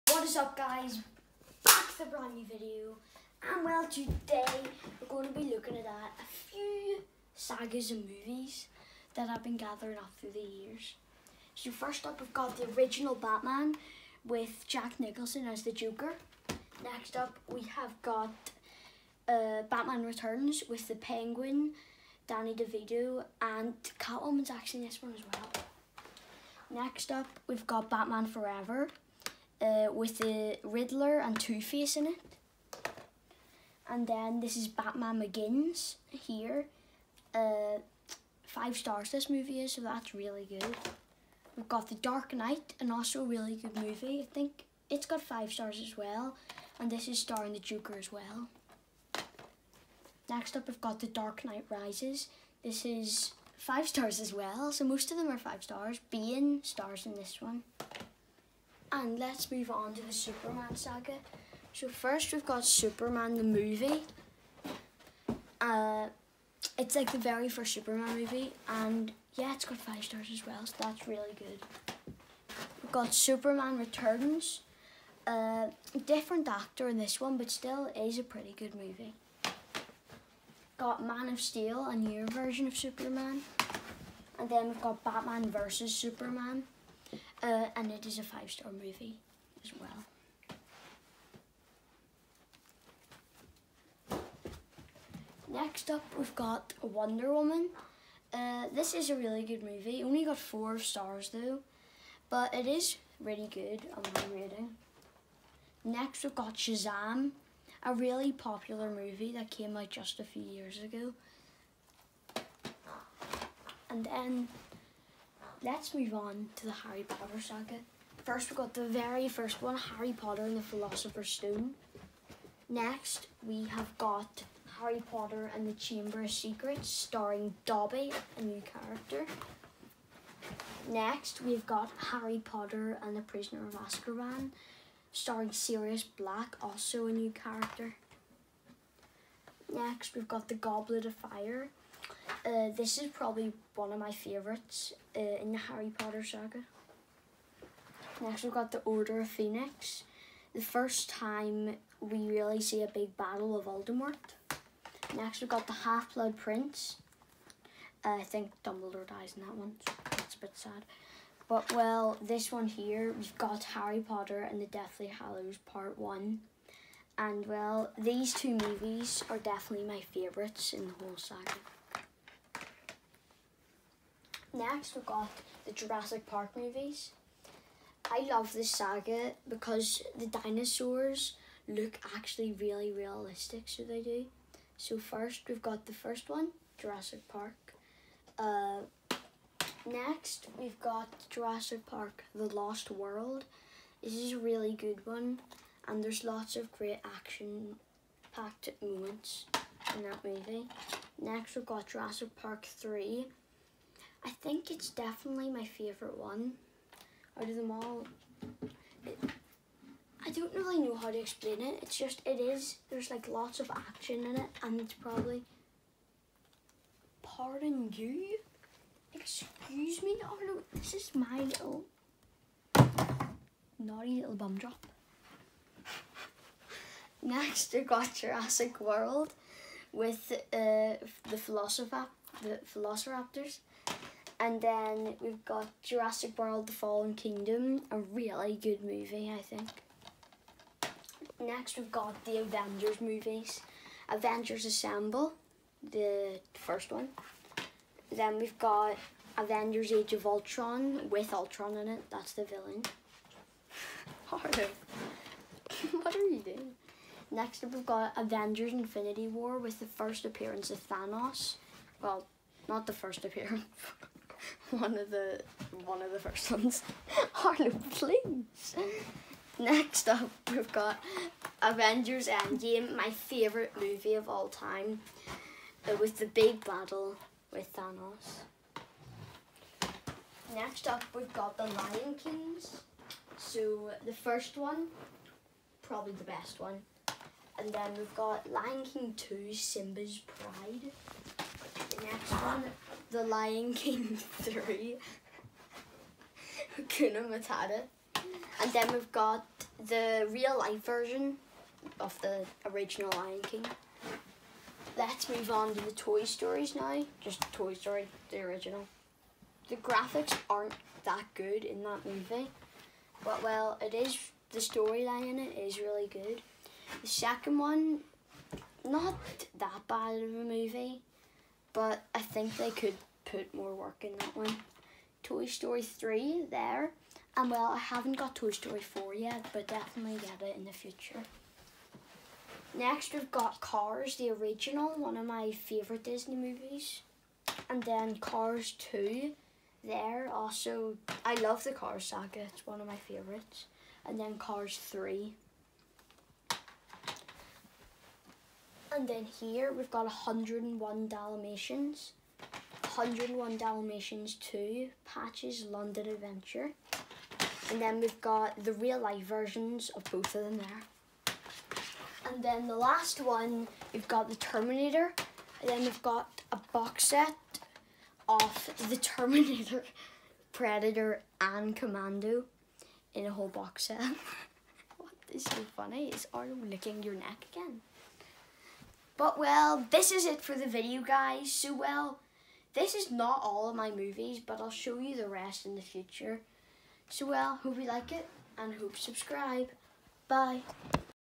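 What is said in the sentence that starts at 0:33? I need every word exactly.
And then this is Batman Begins here.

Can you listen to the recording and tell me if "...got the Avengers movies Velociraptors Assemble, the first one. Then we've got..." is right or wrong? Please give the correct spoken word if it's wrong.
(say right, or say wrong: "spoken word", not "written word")
wrong: "Avengers", not "Velociraptors".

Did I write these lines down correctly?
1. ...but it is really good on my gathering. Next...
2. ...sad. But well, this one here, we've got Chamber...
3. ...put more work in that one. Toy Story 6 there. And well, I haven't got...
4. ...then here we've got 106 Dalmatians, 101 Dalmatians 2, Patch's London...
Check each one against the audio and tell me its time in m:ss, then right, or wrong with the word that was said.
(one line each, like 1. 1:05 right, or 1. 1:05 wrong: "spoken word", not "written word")
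1. 1:42 wrong: "rating", not "gathering"
2. 2:40 wrong: "Harry", not "Chamber"
3. 5:23 wrong: "3", not "6"
4. 5:49 wrong: "101", not "106".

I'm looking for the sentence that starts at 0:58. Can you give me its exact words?
And let's move on to the Superman saga.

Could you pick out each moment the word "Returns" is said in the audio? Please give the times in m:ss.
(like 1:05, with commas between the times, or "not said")
0:20, 1:13.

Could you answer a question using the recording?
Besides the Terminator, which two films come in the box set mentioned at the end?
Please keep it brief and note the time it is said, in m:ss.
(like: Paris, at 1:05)
Predator and Commando, at 6:10.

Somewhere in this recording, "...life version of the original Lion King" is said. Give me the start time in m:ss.
5:00.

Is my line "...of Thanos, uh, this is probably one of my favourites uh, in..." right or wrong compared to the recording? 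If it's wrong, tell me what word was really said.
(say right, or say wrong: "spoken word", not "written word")
wrong: "Fire", not "Thanos".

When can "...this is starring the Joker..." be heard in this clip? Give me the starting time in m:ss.
0:46.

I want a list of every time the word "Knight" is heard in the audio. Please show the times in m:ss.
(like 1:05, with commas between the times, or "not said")
0:42, 0:51.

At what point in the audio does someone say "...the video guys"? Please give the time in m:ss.
6:20.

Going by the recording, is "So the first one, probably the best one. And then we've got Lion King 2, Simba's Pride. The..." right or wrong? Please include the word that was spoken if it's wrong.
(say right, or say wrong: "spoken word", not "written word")
right.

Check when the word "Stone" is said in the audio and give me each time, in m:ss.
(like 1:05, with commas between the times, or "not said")
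2:01.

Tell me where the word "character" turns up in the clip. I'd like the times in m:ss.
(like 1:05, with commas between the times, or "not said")
2:08, 2:17.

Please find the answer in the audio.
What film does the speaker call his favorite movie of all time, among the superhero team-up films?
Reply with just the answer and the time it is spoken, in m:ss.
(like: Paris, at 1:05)
Avengers Endgame, at 4:31.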